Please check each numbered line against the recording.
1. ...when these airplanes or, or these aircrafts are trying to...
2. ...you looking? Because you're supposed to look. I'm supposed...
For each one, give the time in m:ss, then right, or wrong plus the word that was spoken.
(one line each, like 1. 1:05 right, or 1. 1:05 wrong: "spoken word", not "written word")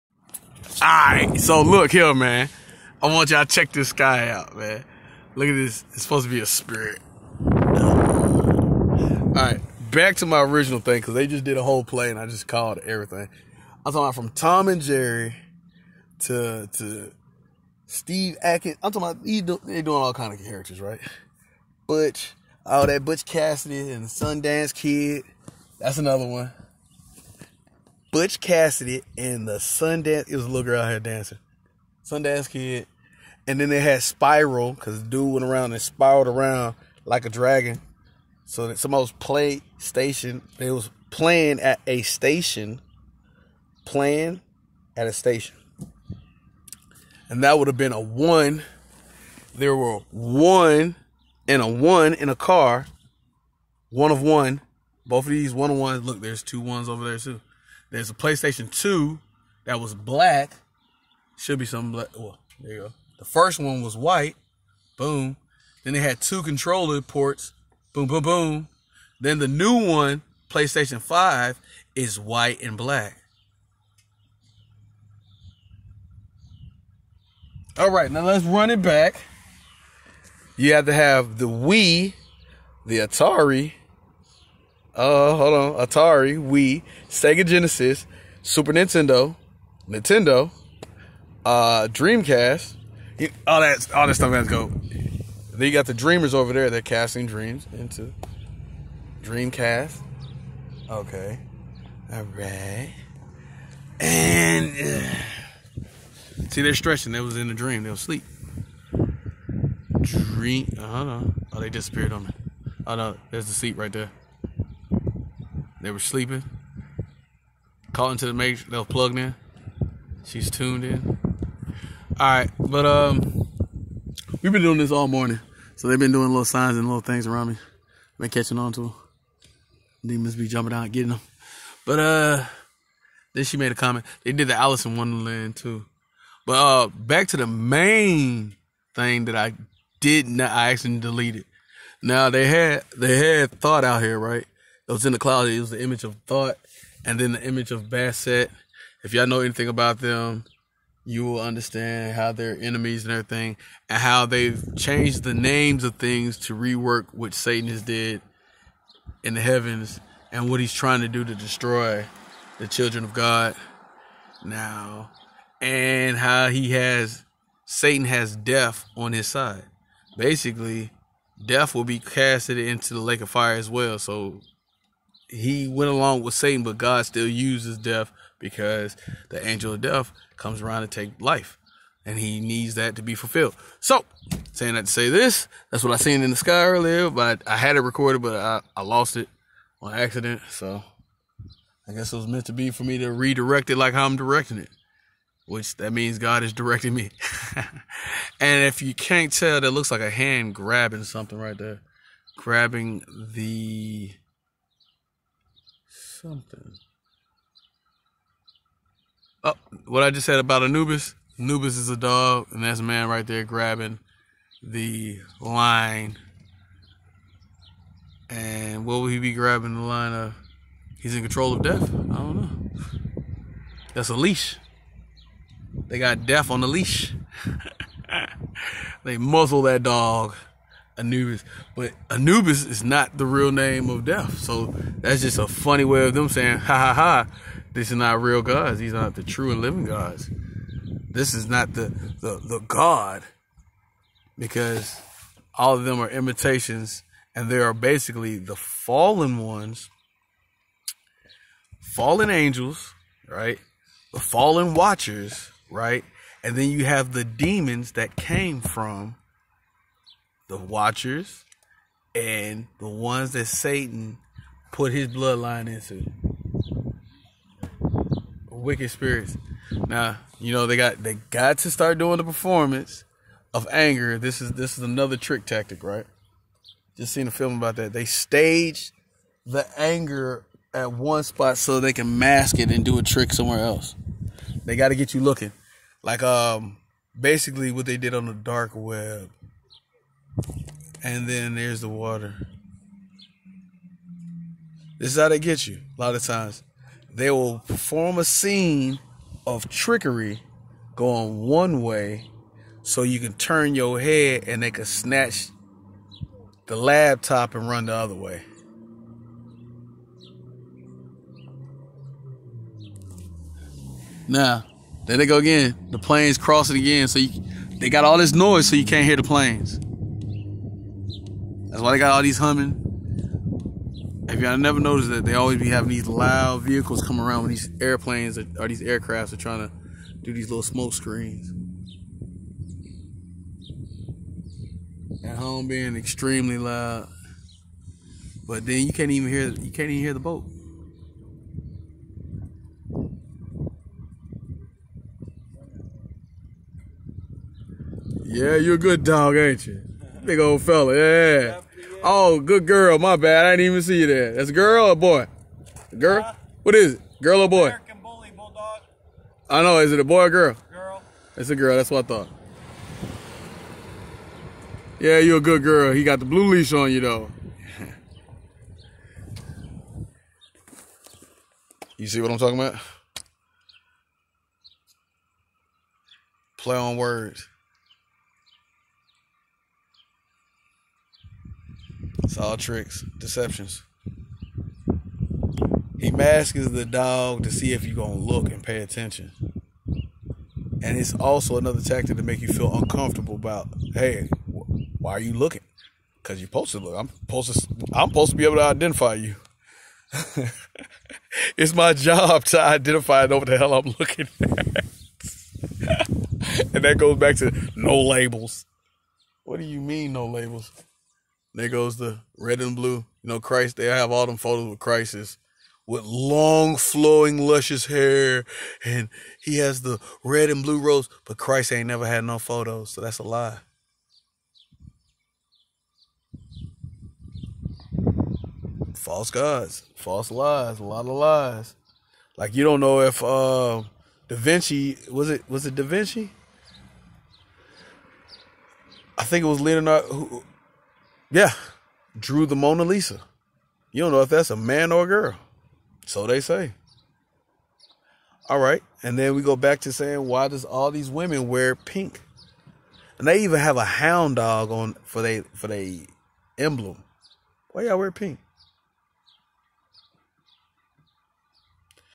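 1. 5:27 right
2. 6:35 right.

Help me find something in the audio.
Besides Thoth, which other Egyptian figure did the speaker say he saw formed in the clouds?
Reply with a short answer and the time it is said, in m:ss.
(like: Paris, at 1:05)
Bastet, at 2:27.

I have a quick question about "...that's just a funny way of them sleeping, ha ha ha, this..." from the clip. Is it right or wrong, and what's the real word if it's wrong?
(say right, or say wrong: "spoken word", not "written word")
wrong: "saying", not "sleeping".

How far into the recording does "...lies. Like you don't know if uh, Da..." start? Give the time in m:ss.
7:11.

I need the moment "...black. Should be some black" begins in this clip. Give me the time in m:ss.
0:59.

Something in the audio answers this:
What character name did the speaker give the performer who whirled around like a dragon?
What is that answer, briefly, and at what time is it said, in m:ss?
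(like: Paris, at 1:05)
Spiral, at 0:34.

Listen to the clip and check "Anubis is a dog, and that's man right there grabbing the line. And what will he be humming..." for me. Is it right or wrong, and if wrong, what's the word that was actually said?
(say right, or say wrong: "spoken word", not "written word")
wrong: "grabbing", not "humming".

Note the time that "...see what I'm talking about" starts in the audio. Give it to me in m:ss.
6:12.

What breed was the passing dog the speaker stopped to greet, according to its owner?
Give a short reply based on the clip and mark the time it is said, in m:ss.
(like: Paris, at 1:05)
American Bully Bulldog, at 5:57.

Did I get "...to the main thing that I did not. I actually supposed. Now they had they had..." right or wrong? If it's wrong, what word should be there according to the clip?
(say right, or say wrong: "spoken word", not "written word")
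wrong: "deleted", not "supposed".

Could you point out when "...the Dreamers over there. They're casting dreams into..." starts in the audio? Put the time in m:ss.
1:35.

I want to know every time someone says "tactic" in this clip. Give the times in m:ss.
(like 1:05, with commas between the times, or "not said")
4:35, 6:31.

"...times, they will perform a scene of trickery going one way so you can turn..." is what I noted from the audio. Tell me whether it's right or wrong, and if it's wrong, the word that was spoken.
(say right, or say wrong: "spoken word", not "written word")
right.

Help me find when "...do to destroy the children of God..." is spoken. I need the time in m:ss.
2:41.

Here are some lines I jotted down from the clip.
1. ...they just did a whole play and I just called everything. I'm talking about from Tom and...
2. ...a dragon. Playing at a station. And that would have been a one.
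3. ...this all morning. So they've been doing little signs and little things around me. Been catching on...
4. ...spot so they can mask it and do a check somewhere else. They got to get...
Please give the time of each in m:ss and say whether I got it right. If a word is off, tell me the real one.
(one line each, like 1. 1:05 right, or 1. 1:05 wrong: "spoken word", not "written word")
1. 0:11 right
2. 0:41 wrong: "station", not "dragon"
3. 2:04 right
4. 4:41 wrong: "trick", not "check".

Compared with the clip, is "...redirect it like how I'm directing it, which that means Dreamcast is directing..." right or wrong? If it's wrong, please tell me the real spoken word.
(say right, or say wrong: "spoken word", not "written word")
wrong: "God", not "Dreamcast".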